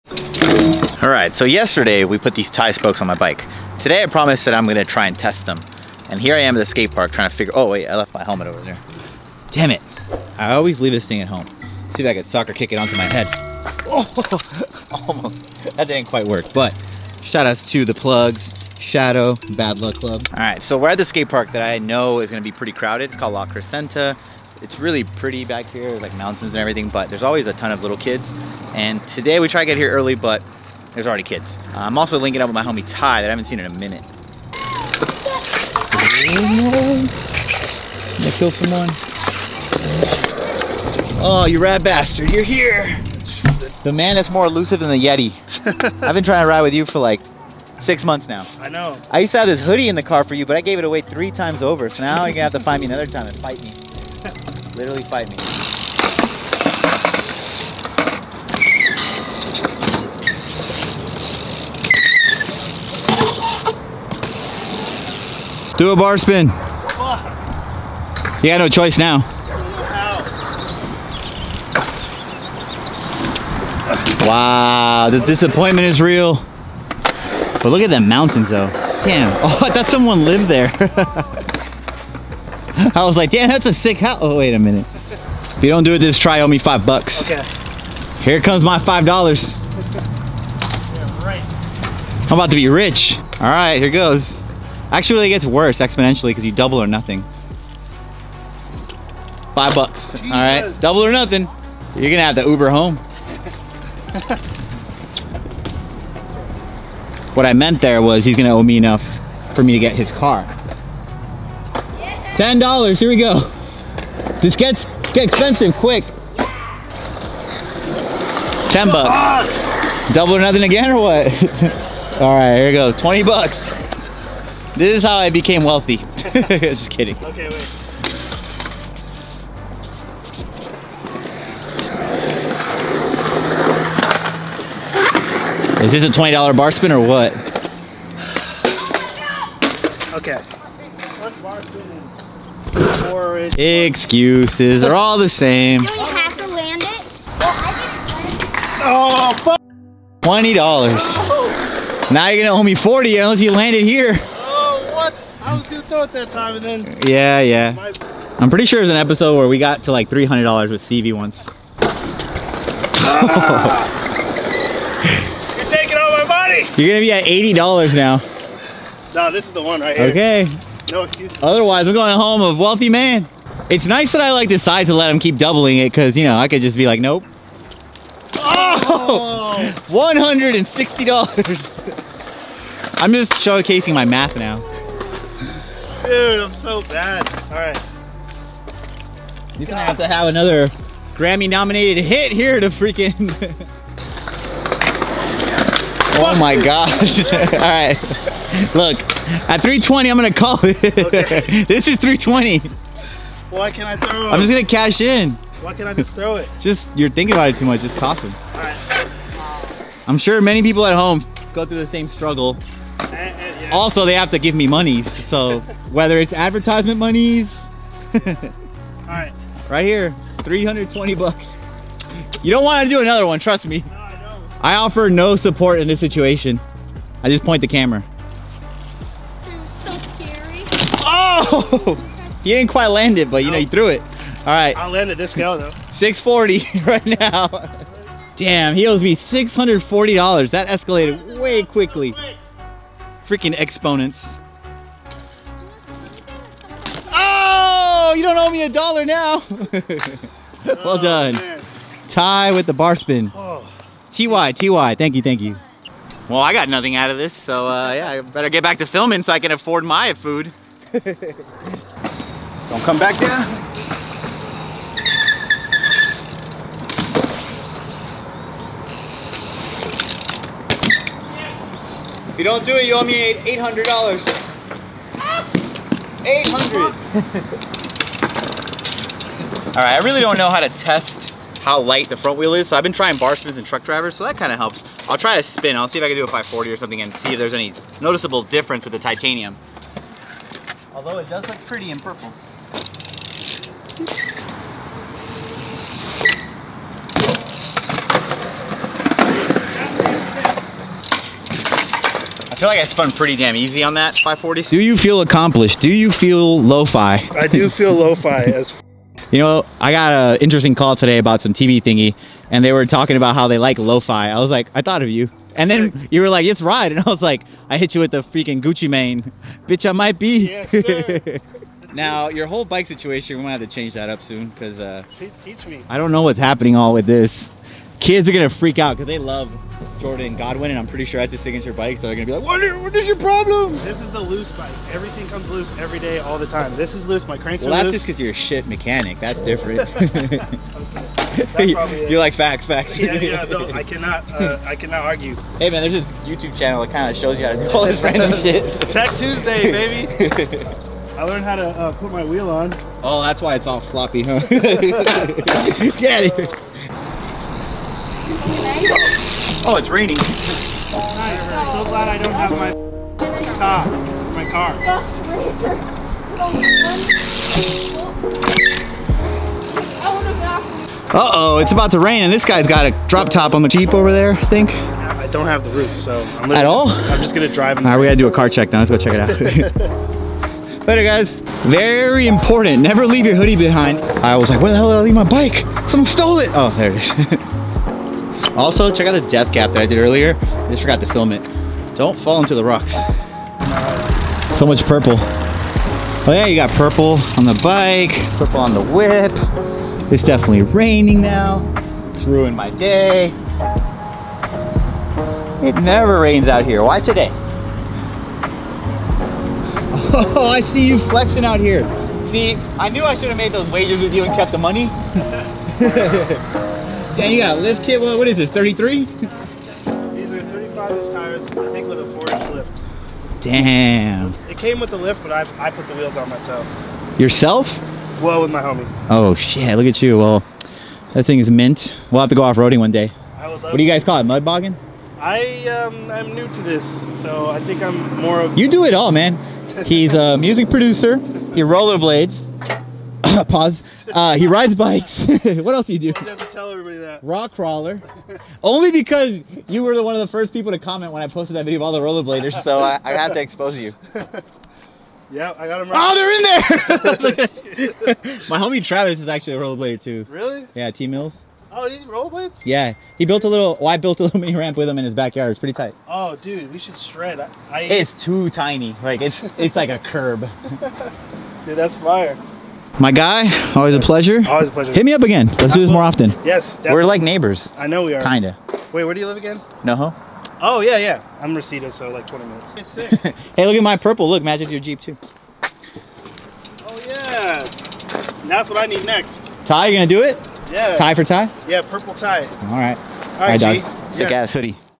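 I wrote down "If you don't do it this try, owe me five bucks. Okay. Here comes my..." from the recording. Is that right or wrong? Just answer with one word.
right.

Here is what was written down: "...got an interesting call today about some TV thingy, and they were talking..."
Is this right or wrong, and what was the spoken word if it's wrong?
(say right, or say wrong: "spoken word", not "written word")
right.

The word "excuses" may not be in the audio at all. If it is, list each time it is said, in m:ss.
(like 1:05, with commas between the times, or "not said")
2:23, 2:51.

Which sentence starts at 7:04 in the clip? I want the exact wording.
It came with the lift, but I, I put the wheels on myself.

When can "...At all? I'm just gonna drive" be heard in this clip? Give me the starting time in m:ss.
6:16.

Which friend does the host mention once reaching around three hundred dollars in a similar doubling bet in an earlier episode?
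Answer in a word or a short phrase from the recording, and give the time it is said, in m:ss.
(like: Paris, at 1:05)
Stevie, at 2:40.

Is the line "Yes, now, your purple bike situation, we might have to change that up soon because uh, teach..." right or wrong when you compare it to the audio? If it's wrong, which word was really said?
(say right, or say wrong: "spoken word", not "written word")
wrong: "whole", not "purple".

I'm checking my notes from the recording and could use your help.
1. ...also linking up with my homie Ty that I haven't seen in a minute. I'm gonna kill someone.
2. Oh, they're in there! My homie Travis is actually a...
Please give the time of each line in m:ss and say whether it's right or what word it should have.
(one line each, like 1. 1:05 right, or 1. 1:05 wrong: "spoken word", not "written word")
1. 0:31 right
2. 7:36 right.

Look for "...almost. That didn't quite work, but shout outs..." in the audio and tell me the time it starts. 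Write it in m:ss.
0:14.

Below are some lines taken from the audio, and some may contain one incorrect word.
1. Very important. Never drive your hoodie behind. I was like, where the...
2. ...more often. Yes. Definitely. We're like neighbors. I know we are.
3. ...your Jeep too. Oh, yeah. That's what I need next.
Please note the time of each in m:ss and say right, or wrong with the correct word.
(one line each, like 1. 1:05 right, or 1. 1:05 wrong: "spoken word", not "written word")
1. 6:21 wrong: "leave", not "drive"
2. 7:55 right
3. 8:04 right.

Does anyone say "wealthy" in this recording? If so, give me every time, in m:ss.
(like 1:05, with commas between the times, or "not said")
2:05, 2:52.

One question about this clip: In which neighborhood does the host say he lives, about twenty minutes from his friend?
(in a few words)
Reseda.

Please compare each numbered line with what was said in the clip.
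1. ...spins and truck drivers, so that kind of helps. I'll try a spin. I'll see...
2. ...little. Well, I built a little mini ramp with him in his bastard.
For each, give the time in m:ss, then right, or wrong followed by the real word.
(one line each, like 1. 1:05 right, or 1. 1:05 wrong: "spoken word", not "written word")
1. 4:43 right
2. 7:43 wrong: "backyard", not "bastard".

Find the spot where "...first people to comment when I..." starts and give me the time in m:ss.
7:30.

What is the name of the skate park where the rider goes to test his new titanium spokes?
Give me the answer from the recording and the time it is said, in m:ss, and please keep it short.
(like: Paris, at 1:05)
La Crescenta, at 0:23.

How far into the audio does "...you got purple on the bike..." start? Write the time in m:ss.
6:36.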